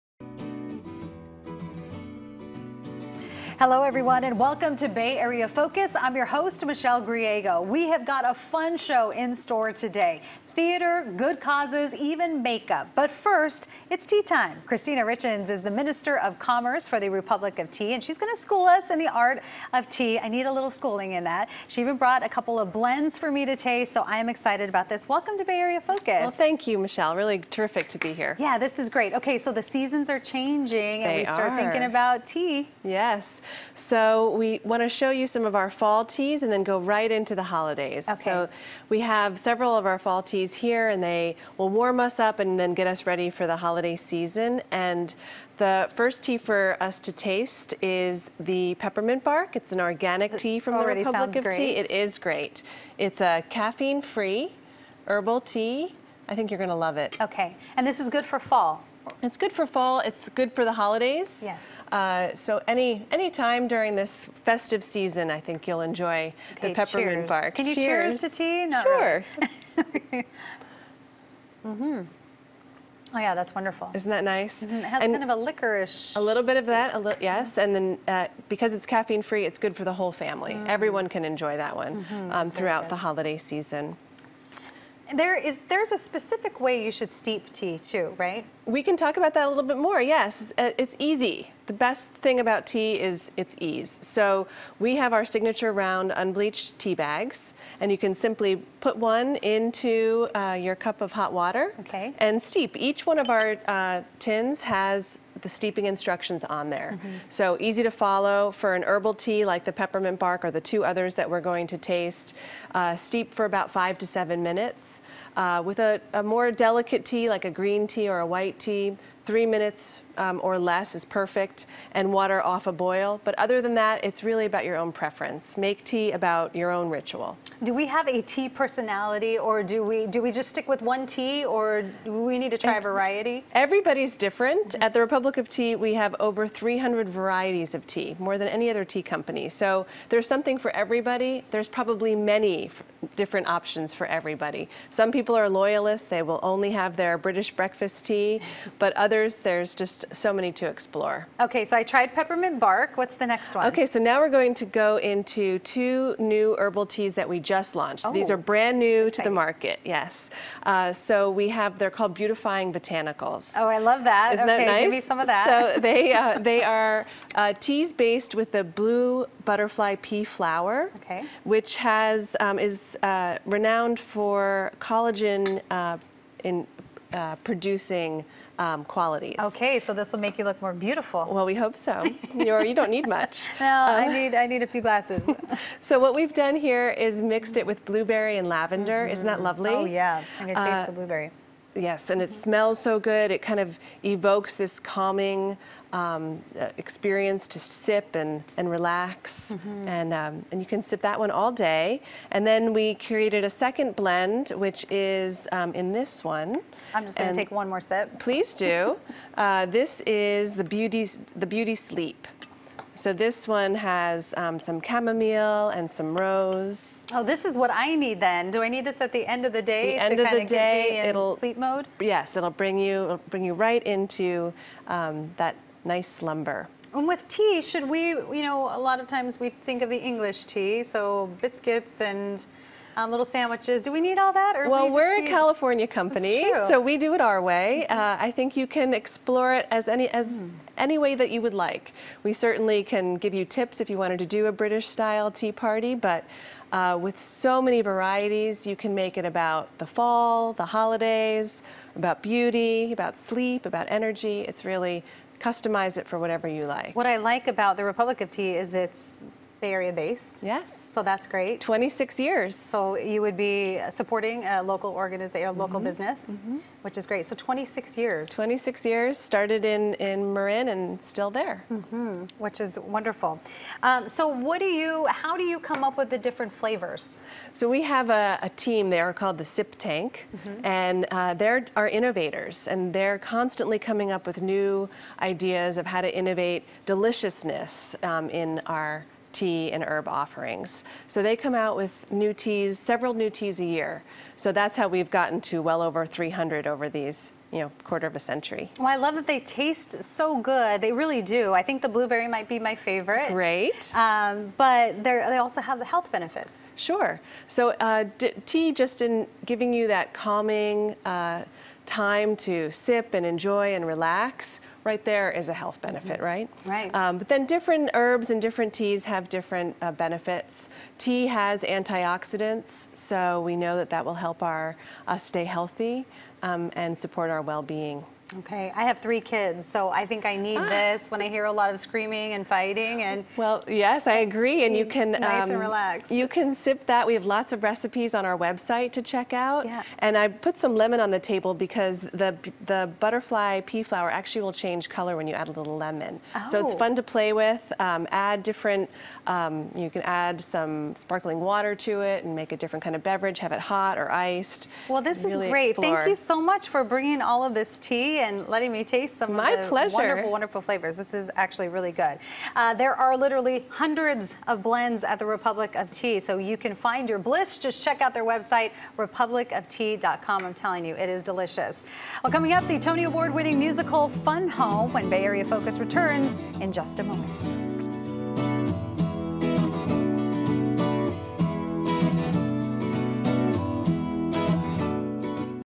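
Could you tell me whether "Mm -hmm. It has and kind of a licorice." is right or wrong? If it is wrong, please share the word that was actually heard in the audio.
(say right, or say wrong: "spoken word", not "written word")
right.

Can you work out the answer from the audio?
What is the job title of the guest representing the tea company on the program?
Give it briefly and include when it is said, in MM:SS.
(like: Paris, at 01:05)
Minister of Commerce, at 00:15.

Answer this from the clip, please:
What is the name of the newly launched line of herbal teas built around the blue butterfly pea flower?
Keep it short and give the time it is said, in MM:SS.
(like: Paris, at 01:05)
Beautifying Botanicals, at 02:42.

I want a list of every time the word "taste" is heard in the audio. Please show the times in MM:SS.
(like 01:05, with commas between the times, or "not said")
00:23, 00:47, 01:51, 03:10, 04:59, 05:58.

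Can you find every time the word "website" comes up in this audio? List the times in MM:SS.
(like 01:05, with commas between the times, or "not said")
05:38, 06:08.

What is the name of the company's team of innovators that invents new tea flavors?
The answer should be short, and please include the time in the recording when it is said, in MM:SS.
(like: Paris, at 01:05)
Sip Tank, at 04:39.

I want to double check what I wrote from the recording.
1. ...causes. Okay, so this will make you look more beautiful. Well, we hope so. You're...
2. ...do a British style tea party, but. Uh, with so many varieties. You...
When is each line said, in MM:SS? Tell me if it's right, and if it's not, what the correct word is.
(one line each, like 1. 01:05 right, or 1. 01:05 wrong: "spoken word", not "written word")
1. 02:58 wrong: "qualities", not "causes"
2. 04:04 right.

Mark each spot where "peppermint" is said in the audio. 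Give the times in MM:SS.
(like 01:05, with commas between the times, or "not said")
00:48, 01:06, 01:49, 02:32.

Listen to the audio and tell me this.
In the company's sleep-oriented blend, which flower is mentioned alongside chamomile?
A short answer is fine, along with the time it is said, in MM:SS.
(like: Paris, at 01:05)
rose, at 03:36.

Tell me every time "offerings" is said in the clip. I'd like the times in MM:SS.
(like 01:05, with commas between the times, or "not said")
04:50.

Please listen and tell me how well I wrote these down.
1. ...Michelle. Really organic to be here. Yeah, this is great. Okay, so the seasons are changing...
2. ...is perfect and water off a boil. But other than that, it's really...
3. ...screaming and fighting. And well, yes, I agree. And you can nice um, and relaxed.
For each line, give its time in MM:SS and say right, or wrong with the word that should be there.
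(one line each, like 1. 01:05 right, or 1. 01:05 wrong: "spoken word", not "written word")
1. 00:26 wrong: "terrific", not "organic"
2. 02:00 right
3. 05:31 right.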